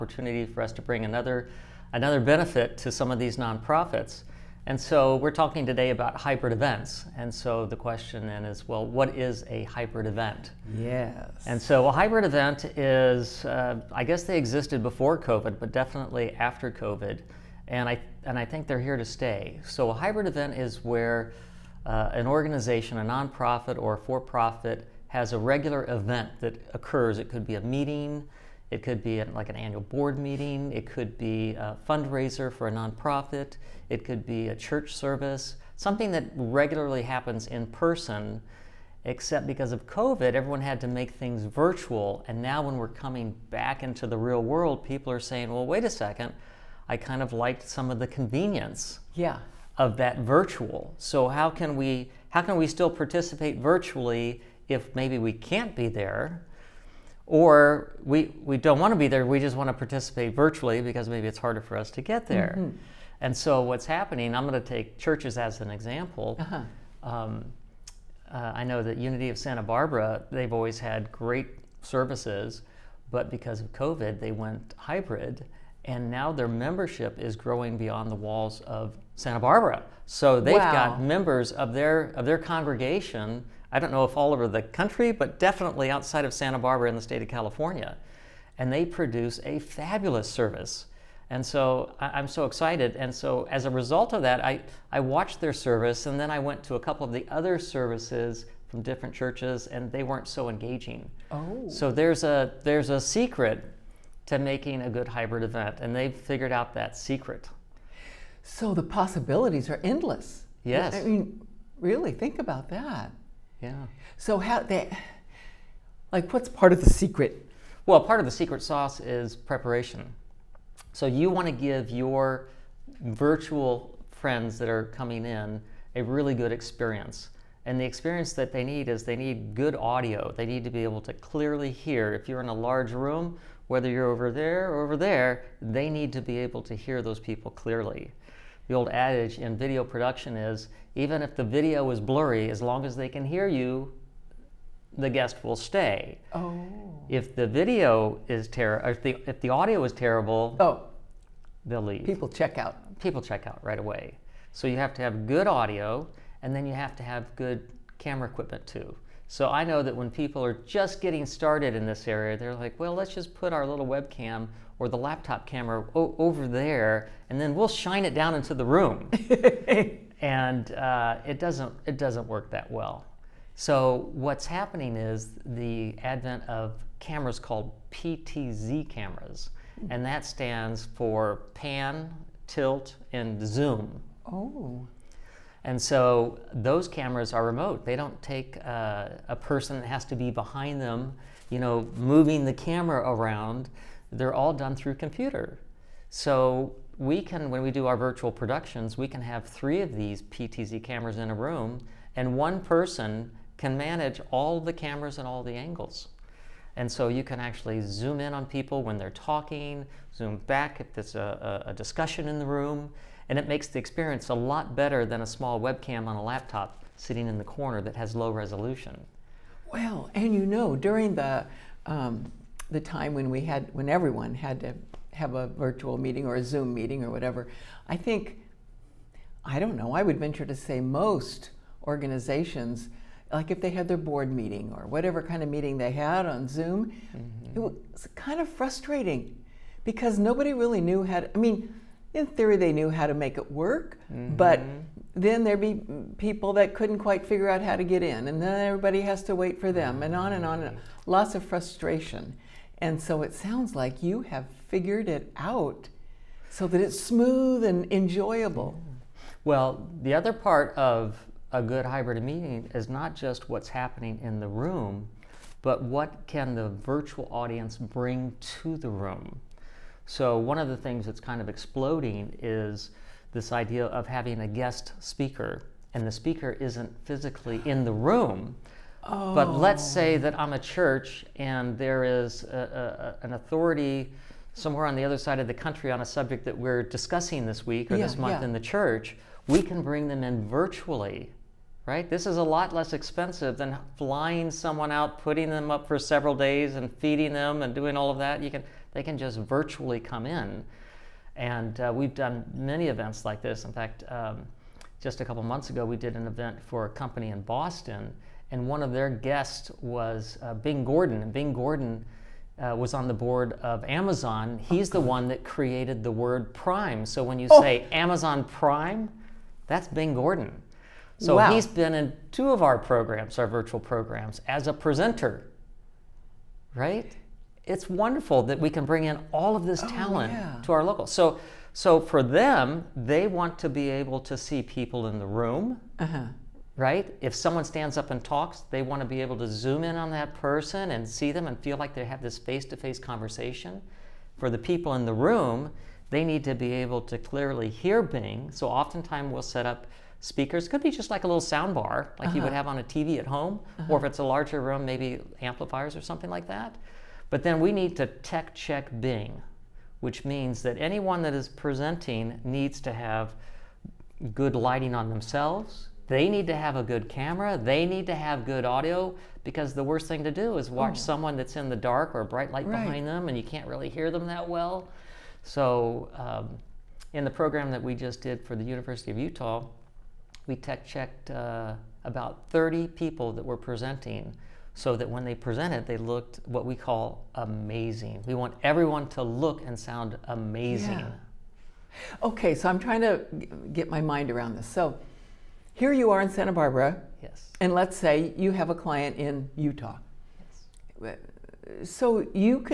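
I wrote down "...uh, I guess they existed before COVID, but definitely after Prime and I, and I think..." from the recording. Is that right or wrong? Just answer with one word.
wrong.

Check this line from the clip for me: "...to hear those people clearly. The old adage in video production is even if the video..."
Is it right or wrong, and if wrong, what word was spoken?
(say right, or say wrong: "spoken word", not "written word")
right.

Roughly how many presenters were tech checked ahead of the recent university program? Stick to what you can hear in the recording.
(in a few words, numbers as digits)
30.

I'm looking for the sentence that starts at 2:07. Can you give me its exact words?
And the experience that they need is they need good audio.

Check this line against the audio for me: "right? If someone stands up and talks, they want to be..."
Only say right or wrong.
right.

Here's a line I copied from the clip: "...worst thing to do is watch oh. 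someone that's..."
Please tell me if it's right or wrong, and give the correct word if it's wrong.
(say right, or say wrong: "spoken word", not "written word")
right.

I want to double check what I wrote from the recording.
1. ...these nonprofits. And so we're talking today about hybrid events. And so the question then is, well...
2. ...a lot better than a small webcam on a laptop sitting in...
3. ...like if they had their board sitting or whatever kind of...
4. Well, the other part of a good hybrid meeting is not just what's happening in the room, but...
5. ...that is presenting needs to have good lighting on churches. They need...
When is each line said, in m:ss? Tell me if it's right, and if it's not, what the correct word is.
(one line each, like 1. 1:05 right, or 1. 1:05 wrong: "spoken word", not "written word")
1. 0:03 right
2. 3:34 right
3. 3:53 wrong: "meeting", not "sitting"
4. 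4:19 right
5. 6:01 wrong: "themselves", not "churches".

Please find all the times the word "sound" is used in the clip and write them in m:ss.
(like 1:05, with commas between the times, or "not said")
4:13, 5:51, 6:29.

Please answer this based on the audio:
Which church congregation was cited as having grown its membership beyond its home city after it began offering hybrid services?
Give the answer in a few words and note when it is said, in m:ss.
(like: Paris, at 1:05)
Unity of Santa Barbara, at 1:08.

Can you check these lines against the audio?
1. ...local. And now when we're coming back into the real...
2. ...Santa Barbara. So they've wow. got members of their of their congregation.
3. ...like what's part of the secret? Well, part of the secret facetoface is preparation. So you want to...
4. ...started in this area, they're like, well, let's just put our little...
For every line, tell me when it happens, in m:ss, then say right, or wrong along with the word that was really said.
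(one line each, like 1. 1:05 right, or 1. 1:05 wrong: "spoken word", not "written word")
1. 0:41 wrong: "virtual", not "local"
2. 1:19 right
3. 1:56 wrong: "sauce", not "facetoface"
4. 2:41 right.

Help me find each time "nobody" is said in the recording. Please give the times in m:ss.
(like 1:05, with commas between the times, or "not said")
4:00.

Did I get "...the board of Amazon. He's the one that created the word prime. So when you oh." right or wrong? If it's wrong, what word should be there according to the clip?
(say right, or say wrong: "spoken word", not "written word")
right.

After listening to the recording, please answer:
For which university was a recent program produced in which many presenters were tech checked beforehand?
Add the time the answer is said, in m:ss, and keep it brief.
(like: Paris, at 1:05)
University of Utah, at 6:18.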